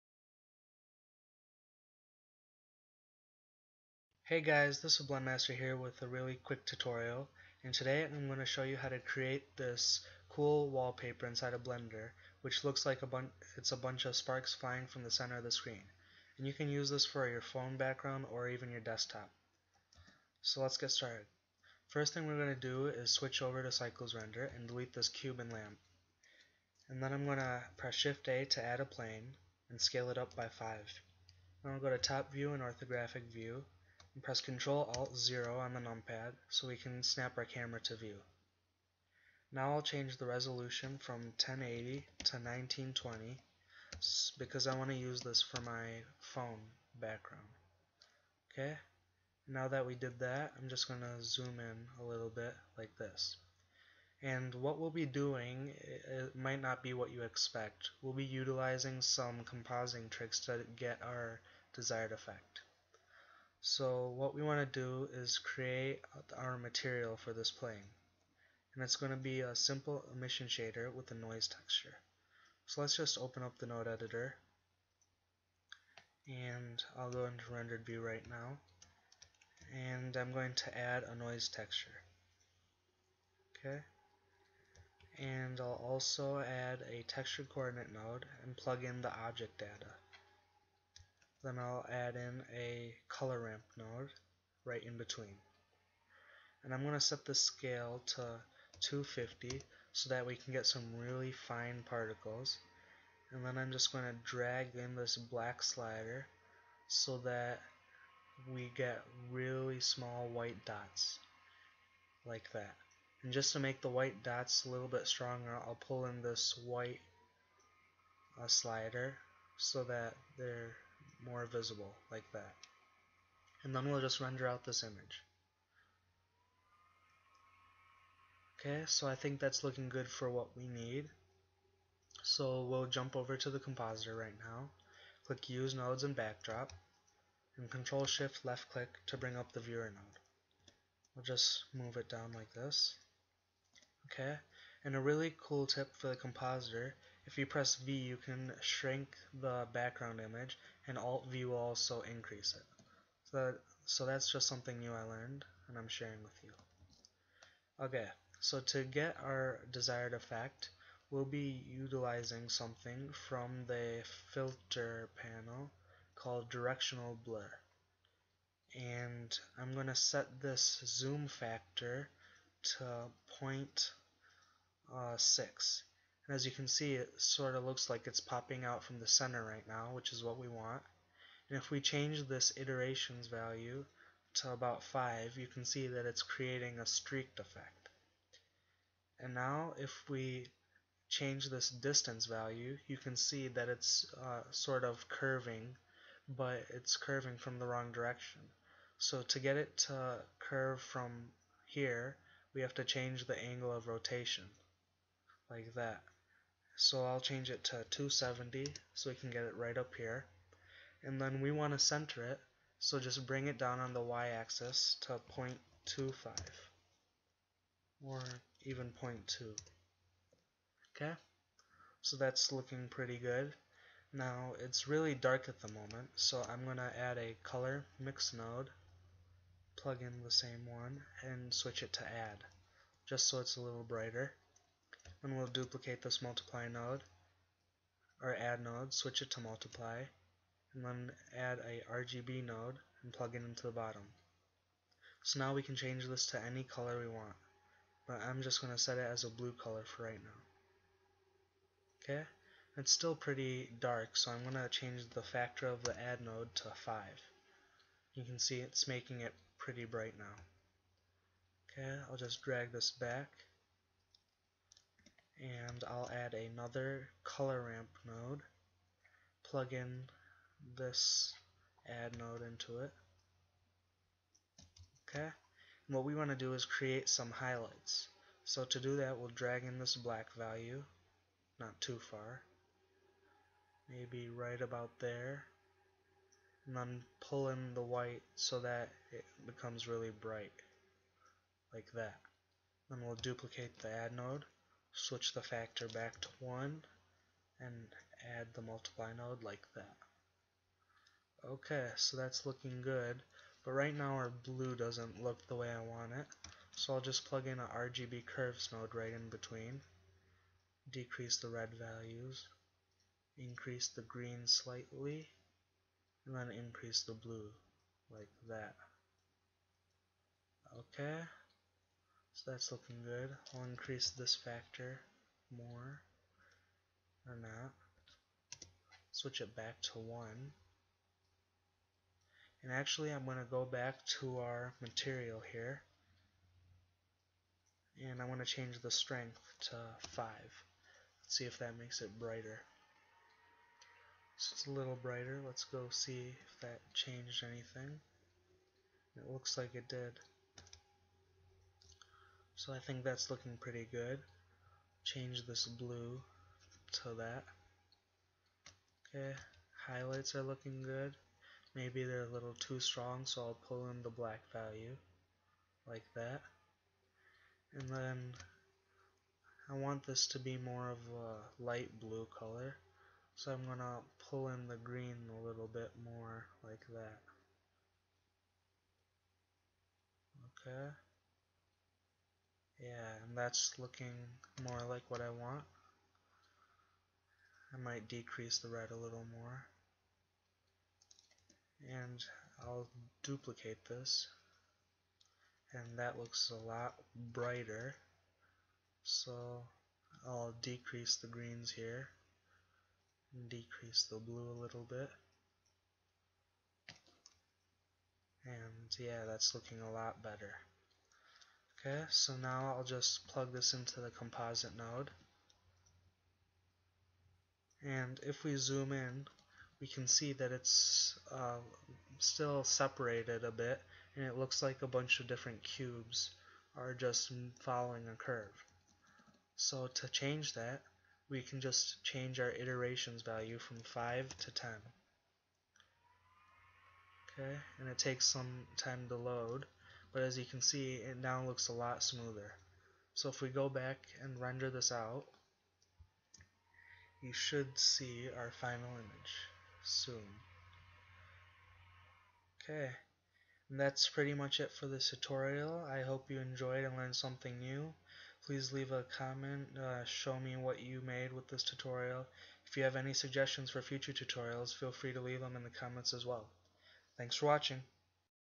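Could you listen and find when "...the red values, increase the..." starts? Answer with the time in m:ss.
5:11.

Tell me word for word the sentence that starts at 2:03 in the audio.
And then we'll just render out this image.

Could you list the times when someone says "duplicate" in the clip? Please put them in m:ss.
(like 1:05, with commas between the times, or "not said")
3:55, 4:53, 6:33.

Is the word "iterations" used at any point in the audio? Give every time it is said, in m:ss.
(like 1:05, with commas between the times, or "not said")
3:02, 7:12.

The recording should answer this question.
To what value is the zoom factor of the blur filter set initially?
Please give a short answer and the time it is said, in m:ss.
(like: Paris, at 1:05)
0.6, at 2:53.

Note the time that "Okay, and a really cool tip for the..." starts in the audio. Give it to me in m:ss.
2:24.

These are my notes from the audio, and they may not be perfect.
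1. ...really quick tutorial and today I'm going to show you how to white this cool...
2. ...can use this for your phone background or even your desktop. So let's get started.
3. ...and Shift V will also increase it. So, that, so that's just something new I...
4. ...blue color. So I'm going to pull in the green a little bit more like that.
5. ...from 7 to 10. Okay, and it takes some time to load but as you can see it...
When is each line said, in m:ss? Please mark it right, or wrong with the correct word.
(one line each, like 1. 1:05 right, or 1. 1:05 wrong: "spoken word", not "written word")
1. 0:06 wrong: "create", not "white"
2. 0:16 right
3. 2:30 wrong: "Alt", not "Shift"
4. 6:11 right
5. 7:13 wrong: "5", not "7".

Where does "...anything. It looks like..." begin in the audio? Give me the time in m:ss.
5:47.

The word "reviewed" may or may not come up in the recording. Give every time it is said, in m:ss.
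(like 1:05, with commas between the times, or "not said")
not said.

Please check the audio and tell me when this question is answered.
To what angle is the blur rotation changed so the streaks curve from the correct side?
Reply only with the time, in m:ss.
3:27.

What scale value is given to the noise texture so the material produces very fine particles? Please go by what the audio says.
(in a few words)
250.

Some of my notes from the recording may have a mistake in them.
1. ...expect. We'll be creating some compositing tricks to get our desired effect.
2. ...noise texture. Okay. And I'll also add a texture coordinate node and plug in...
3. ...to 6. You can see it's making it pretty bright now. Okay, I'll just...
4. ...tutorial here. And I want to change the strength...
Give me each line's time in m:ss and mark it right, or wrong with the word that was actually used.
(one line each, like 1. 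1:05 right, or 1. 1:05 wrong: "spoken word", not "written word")
1. 0:57 wrong: "utilizing", not "creating"
2. 1:21 right
3. 4:16 wrong: "5", not "6"
4. 5:34 wrong: "material", not "tutorial".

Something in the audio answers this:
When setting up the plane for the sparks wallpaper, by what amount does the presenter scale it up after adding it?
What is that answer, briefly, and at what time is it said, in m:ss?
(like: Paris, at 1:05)
5, at 0:29.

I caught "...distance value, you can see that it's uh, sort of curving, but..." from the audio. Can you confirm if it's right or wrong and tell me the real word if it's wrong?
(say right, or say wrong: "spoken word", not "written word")
right.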